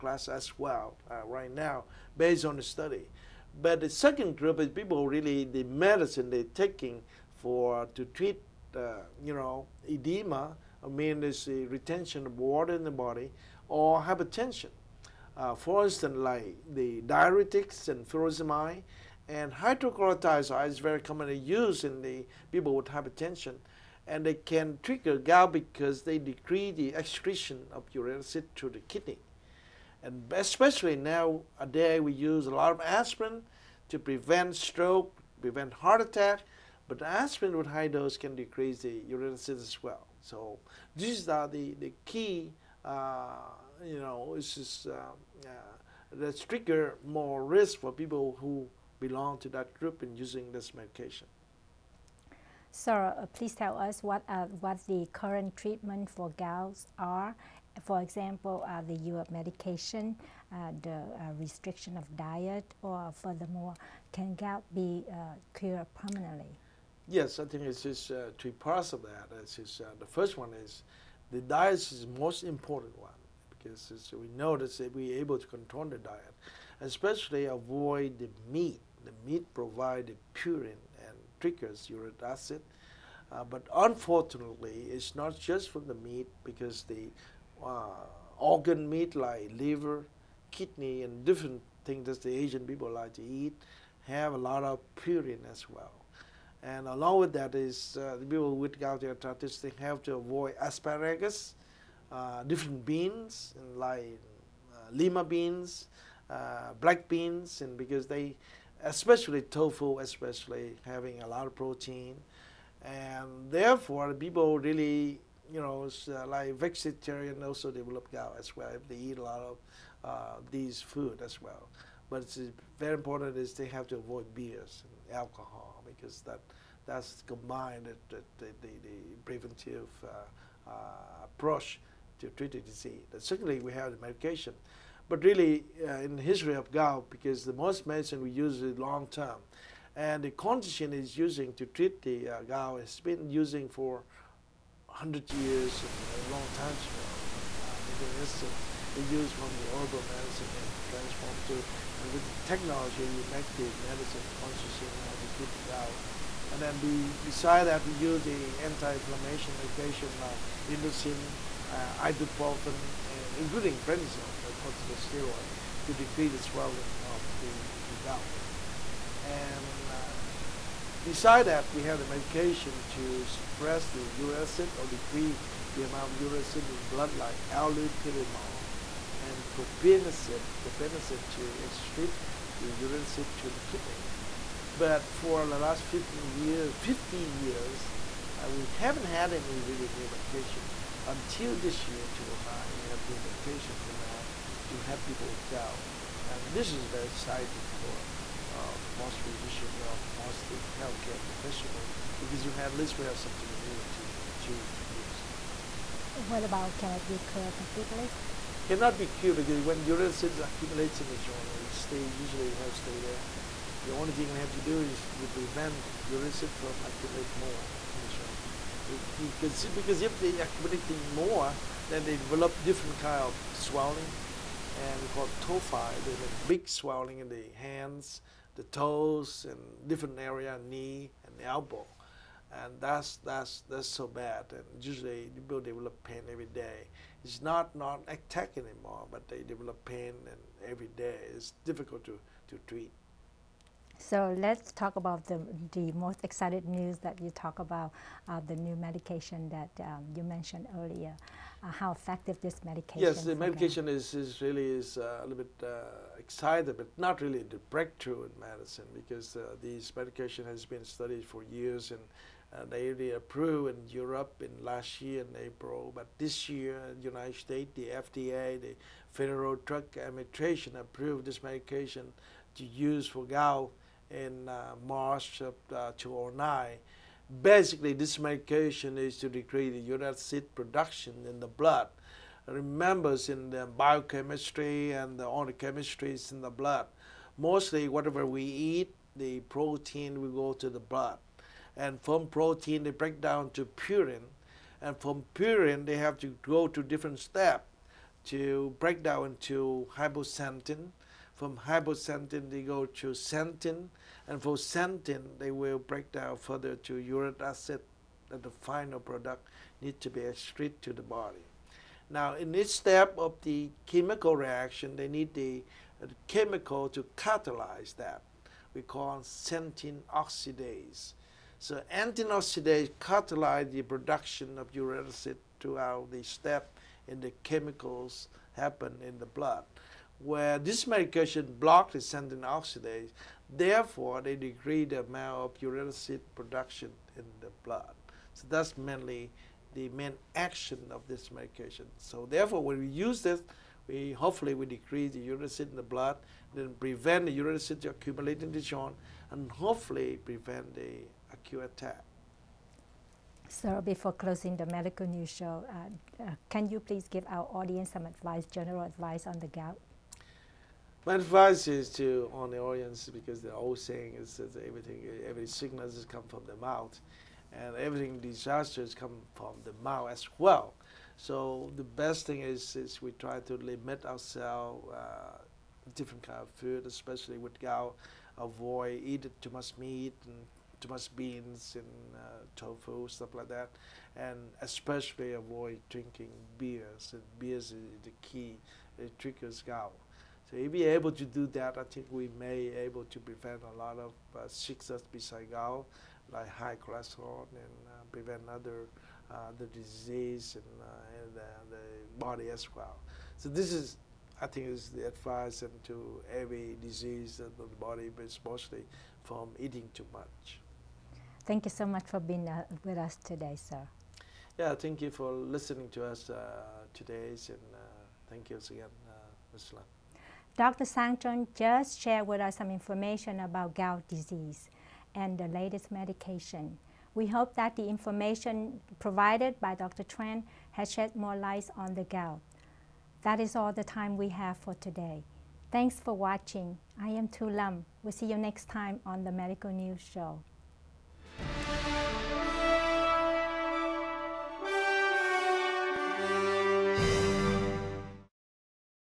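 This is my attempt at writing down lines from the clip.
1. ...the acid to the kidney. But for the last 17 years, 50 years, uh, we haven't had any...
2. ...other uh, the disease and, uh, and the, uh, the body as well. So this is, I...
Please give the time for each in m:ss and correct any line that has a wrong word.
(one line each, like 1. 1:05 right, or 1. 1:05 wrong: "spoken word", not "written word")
1. 3:02 wrong: "15", not "17"
2. 6:38 right.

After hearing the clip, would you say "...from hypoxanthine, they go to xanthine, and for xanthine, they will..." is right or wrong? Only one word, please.
right.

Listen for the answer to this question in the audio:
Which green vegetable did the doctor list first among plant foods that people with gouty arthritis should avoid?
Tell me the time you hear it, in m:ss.
1:40.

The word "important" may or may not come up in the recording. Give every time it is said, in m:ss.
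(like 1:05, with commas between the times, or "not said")
1:12, 2:02.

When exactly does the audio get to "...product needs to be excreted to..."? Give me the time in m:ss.
5:08.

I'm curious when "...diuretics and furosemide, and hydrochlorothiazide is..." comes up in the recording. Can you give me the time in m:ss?
0:17.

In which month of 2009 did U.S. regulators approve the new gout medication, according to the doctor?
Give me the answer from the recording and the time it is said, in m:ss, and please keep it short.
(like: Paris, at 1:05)
March, at 4:34.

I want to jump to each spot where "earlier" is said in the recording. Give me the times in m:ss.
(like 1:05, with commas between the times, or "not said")
4:10.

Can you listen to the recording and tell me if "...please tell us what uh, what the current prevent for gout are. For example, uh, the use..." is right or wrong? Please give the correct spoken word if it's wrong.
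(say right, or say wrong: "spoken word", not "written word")
wrong: "treatment", not "prevent".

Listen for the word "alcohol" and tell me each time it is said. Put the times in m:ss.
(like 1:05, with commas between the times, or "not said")
2:05.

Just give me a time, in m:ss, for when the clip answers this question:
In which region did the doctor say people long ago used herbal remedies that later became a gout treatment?
2:27.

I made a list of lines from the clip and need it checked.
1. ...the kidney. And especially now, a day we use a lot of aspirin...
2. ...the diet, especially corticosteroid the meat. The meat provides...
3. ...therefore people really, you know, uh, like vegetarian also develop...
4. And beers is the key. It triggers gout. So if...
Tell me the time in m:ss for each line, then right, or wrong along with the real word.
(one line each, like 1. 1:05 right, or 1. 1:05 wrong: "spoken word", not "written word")
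1. 0:28 right
2. 1:15 wrong: "avoid", not "corticosteroid"
3. 1:53 right
4. 6:27 right.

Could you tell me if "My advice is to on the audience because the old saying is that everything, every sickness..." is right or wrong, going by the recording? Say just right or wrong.
right.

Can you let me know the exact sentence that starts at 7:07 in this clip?
We hope that the information provided by Dr.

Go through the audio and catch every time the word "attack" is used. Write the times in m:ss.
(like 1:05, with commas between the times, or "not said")
0:36, 3:58, 5:51.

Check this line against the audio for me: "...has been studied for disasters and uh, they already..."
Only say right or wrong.
wrong.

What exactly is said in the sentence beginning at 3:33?
The only thing we have to do is to prevent acid from accumulate more in the joint.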